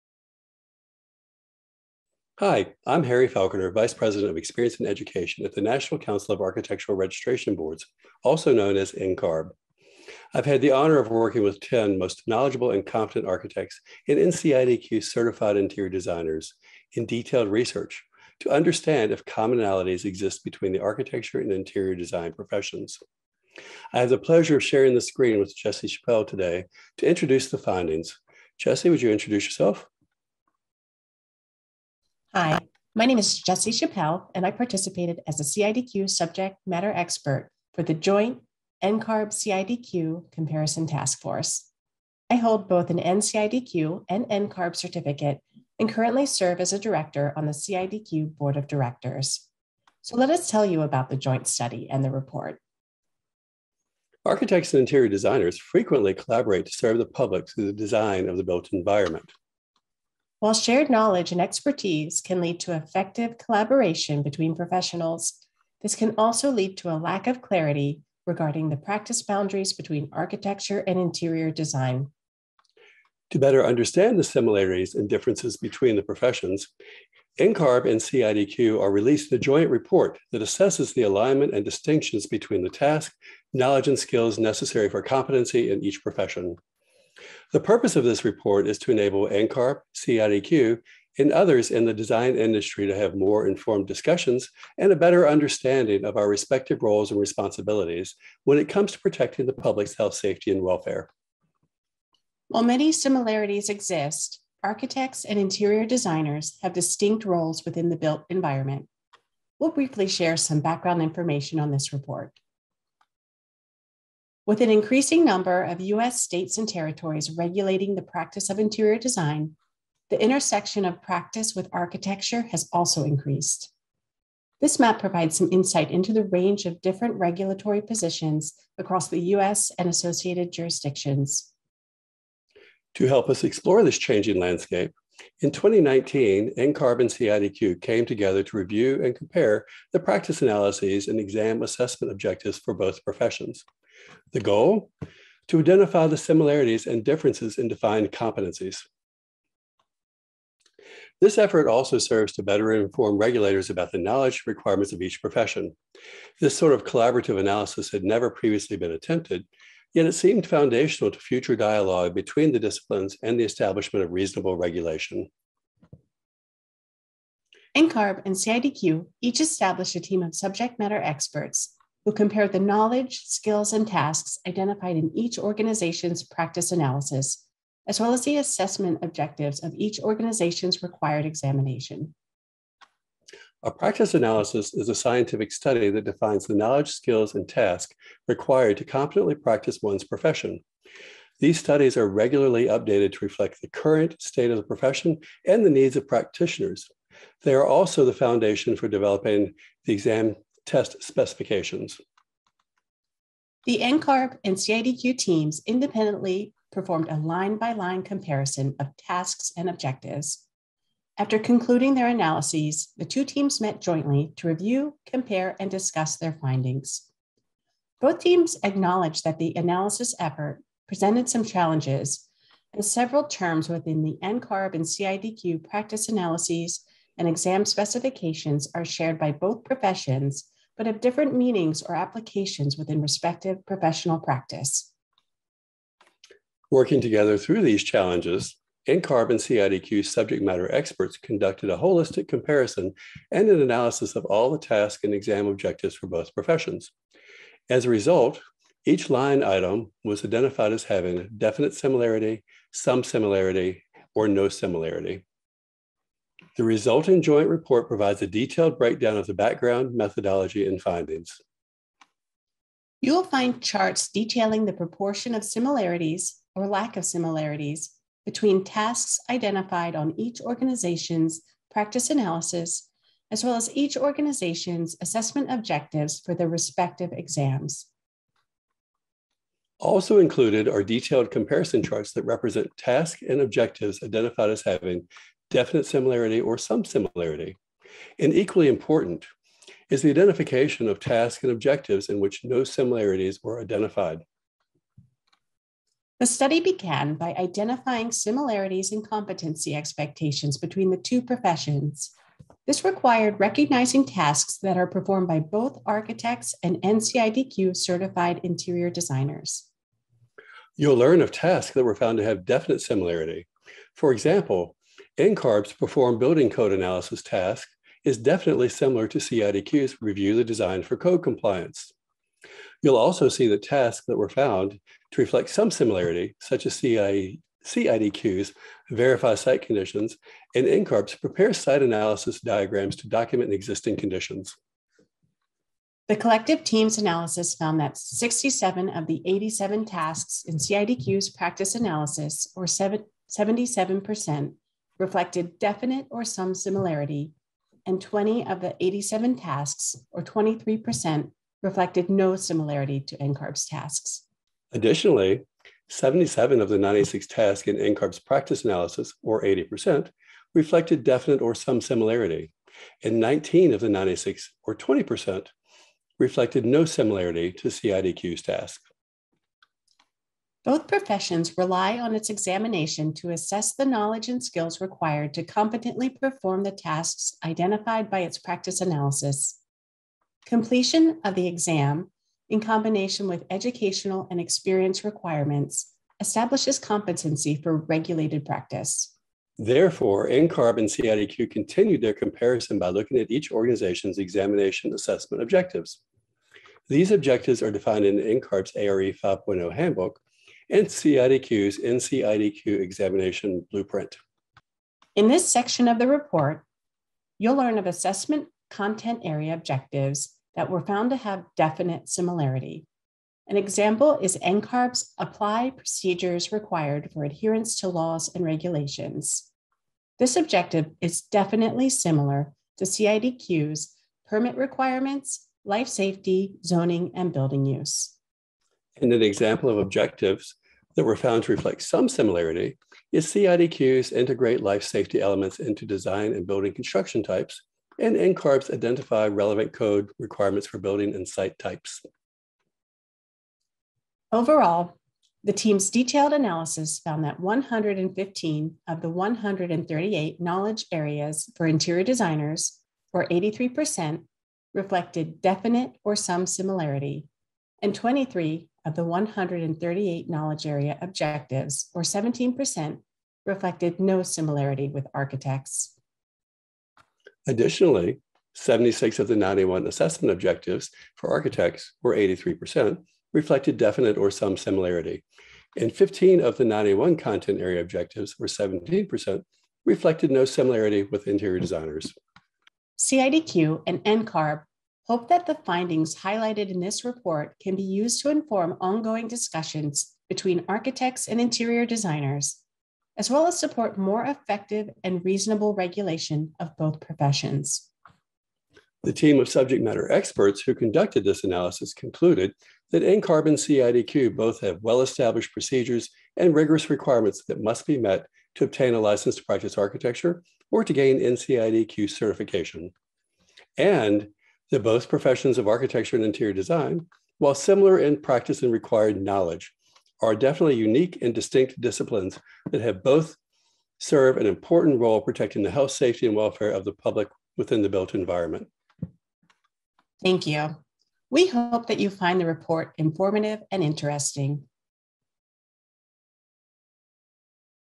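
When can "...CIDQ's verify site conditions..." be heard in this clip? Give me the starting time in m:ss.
5:27.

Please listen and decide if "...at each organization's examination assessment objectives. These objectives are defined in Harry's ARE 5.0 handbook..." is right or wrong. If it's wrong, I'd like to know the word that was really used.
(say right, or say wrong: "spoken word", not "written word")
wrong: "NCARB", not "Harry".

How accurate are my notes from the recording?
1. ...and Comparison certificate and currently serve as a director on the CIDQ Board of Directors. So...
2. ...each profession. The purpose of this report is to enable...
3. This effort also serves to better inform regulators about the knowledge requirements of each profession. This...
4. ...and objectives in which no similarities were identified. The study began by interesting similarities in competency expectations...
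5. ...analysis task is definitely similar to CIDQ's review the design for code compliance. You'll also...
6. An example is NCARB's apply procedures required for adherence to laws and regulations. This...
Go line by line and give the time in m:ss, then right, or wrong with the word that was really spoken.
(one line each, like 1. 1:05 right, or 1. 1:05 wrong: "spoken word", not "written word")
1. 0:44 wrong: "NCARB", not "Comparison"
2. 1:25 right
3. 2:31 right
4. 4:51 wrong: "identifying", not "interesting"
5. 5:16 right
6. 6:53 right.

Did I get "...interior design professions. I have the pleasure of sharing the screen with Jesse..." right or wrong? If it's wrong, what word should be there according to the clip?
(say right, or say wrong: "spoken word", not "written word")
right.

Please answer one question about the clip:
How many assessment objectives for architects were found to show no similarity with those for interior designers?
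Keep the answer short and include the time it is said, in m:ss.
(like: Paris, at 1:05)
15, at 7:55.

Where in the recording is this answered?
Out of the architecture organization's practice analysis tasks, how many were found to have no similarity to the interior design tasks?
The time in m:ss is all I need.
6:03.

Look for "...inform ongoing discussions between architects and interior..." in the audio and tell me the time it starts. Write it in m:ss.
8:08.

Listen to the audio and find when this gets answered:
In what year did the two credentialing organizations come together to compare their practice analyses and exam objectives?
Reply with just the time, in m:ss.
2:15.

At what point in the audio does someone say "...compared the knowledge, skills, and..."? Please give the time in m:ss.
2:52.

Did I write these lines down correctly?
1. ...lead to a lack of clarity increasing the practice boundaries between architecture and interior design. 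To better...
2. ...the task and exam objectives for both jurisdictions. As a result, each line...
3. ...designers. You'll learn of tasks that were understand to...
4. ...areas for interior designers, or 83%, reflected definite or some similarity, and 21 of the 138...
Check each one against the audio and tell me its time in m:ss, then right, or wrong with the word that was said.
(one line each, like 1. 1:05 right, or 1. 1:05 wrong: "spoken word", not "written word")
1. 1:06 wrong: "regarding", not "increasing"
2. 4:04 wrong: "professions", not "jurisdictions"
3. 5:08 wrong: "found", not "understand"
4. 7:30 wrong: "23", not "21".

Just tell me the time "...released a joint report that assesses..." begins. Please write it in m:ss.
1:18.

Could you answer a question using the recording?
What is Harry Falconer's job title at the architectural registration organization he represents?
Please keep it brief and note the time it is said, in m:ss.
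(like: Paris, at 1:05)
Vice President of Experience and Education, at 0:03.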